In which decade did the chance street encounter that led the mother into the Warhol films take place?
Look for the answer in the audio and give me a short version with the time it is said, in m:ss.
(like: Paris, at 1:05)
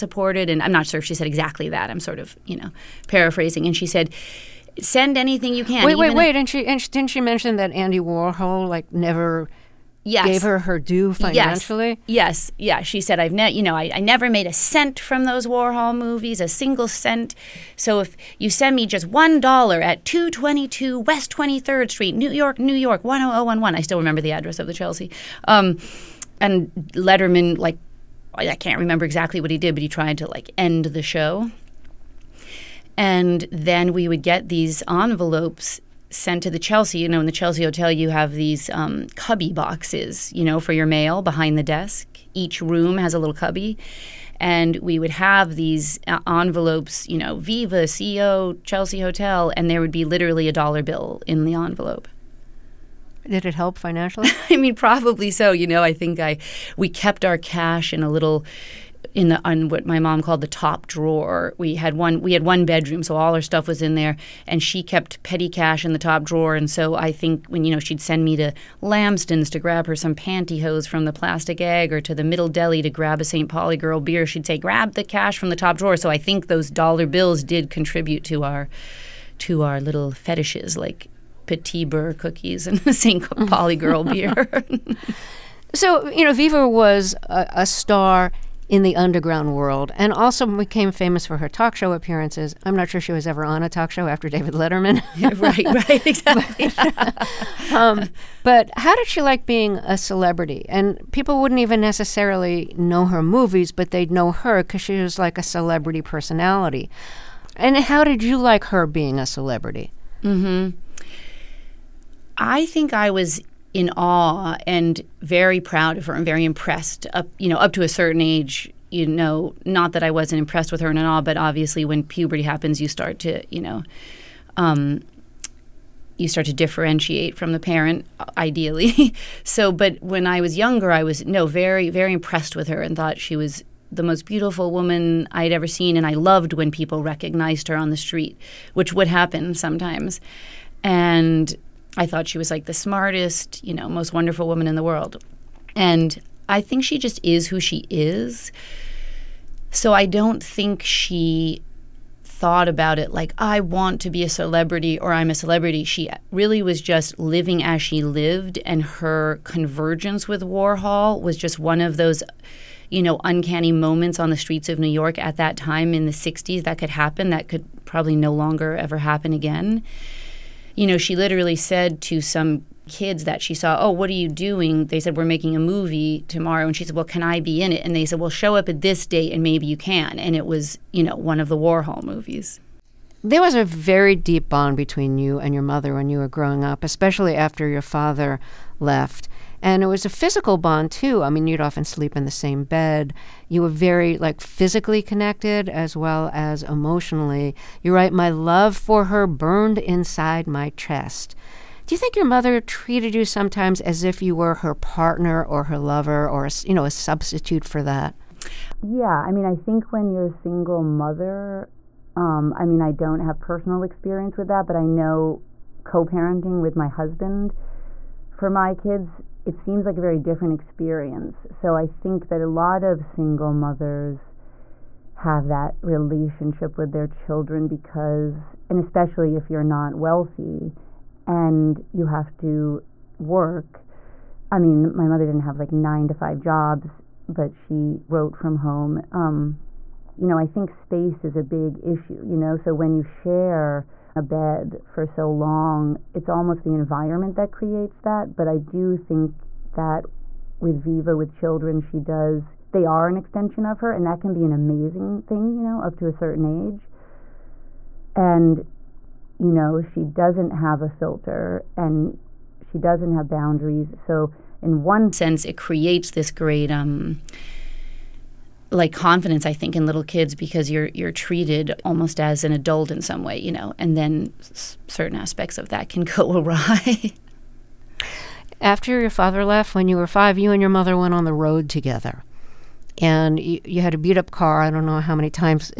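the 60s, at 2:46.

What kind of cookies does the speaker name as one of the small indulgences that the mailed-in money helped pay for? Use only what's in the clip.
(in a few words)
petit beurre cookies.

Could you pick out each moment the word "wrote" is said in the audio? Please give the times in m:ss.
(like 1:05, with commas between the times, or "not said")
3:58.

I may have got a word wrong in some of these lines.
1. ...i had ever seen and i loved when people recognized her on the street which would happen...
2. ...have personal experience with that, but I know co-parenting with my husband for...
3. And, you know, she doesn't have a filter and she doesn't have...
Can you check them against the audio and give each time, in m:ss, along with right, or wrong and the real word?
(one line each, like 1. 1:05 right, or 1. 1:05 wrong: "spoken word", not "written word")
1. 2:15 right
2. 3:33 right
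3. 4:18 right.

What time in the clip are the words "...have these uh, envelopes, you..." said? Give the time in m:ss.
0:45.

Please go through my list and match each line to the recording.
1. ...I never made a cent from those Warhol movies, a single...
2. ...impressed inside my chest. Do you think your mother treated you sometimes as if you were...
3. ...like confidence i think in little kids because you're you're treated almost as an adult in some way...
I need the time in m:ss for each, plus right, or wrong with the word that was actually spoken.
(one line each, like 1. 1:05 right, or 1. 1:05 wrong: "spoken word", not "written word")
1. 0:13 right
2. 3:19 wrong: "burned", not "impressed"
3. 4:28 right.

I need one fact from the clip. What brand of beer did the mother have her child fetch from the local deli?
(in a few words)
St. Pauli Girl.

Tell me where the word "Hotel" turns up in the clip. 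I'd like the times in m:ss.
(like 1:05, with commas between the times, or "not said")
0:37, 0:48.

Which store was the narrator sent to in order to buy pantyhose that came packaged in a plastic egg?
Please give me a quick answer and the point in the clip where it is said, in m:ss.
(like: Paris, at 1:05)
Lamston's, at 1:08.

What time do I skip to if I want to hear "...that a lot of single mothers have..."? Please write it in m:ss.
3:42.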